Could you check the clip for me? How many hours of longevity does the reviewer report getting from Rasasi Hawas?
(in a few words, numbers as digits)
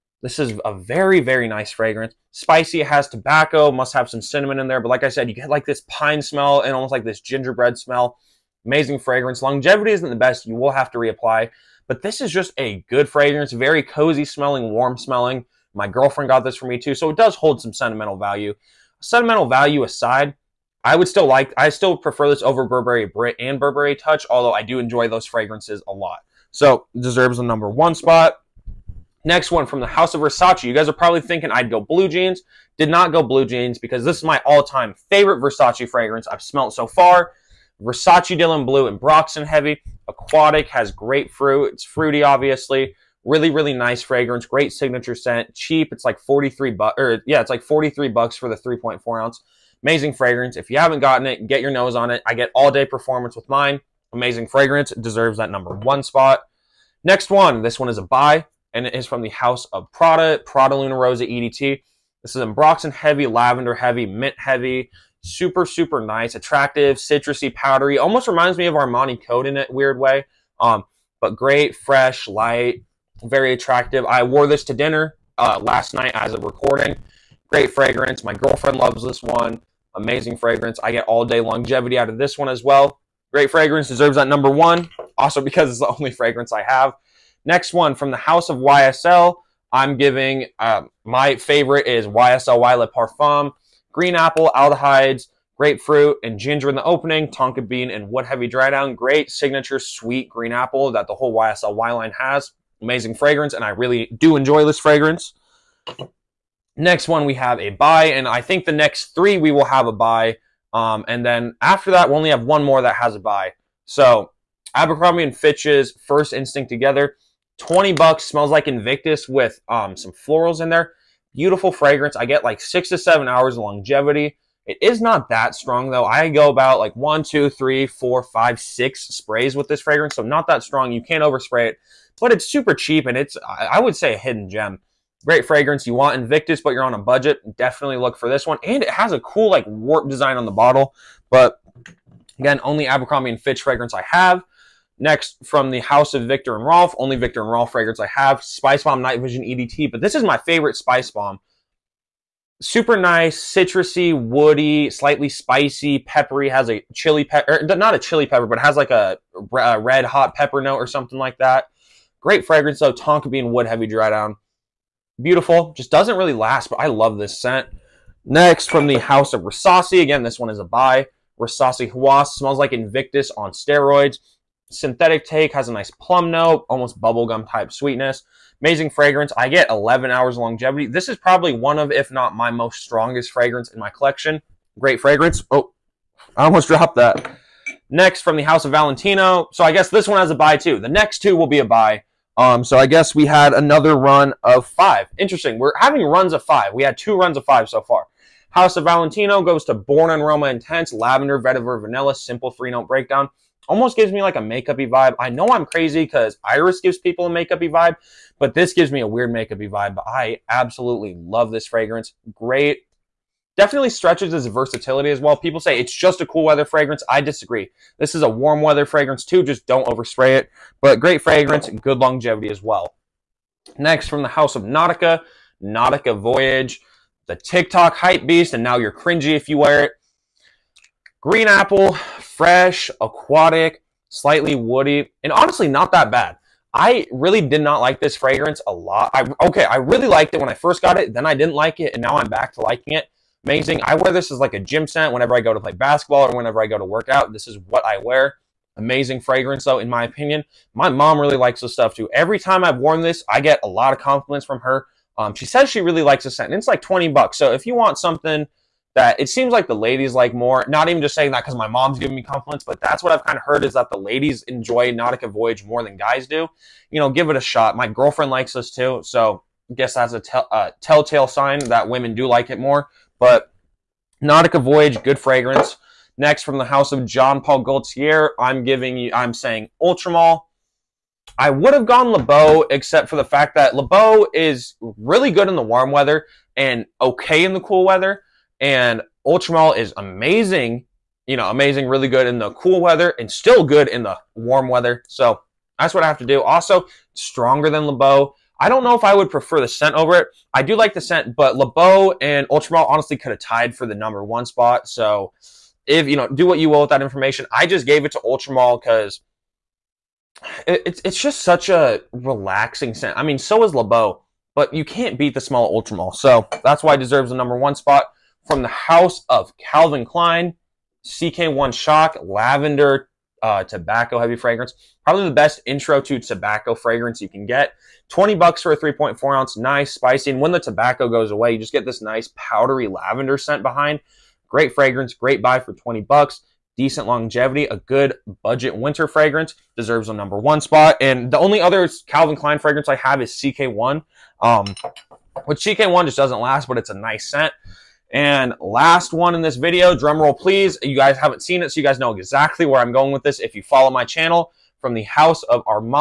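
11 hours.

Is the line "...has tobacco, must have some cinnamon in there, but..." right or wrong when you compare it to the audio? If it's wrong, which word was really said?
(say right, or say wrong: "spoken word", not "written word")
right.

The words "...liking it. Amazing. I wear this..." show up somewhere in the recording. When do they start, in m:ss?
4:02.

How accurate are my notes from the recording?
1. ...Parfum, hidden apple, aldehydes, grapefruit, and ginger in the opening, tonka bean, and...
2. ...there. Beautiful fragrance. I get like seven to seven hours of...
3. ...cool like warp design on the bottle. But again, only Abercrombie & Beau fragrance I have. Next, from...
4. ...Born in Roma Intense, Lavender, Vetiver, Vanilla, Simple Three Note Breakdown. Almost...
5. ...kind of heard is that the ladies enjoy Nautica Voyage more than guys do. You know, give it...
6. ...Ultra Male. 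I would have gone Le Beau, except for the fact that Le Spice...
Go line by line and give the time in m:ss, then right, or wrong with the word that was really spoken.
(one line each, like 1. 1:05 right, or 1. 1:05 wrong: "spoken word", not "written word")
1. 1:32 wrong: "green", not "hidden"
2. 2:00 wrong: "six", not "seven"
3. 2:19 wrong: "Fitch", not "Beau"
4. 3:19 right
5. 4:23 right
6. 4:39 wrong: "Beau", not "Spice".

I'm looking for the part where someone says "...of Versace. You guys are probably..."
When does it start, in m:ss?
0:30.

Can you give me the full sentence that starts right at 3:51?
Green apple, fresh, aquatic, slightly woody, and honestly, not that bad.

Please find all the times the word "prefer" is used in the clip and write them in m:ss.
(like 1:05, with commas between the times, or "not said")
0:21, 4:59.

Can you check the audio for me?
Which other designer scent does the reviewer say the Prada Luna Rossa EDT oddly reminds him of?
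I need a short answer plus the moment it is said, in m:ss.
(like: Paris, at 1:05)
Armani Code, at 1:08.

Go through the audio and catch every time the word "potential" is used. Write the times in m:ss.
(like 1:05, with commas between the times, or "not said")
not said.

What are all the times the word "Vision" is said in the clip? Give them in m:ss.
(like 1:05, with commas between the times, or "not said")
2:29.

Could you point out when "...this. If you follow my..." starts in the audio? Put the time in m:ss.
5:53.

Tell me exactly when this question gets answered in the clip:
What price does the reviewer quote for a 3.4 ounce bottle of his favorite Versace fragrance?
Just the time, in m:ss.
0:47.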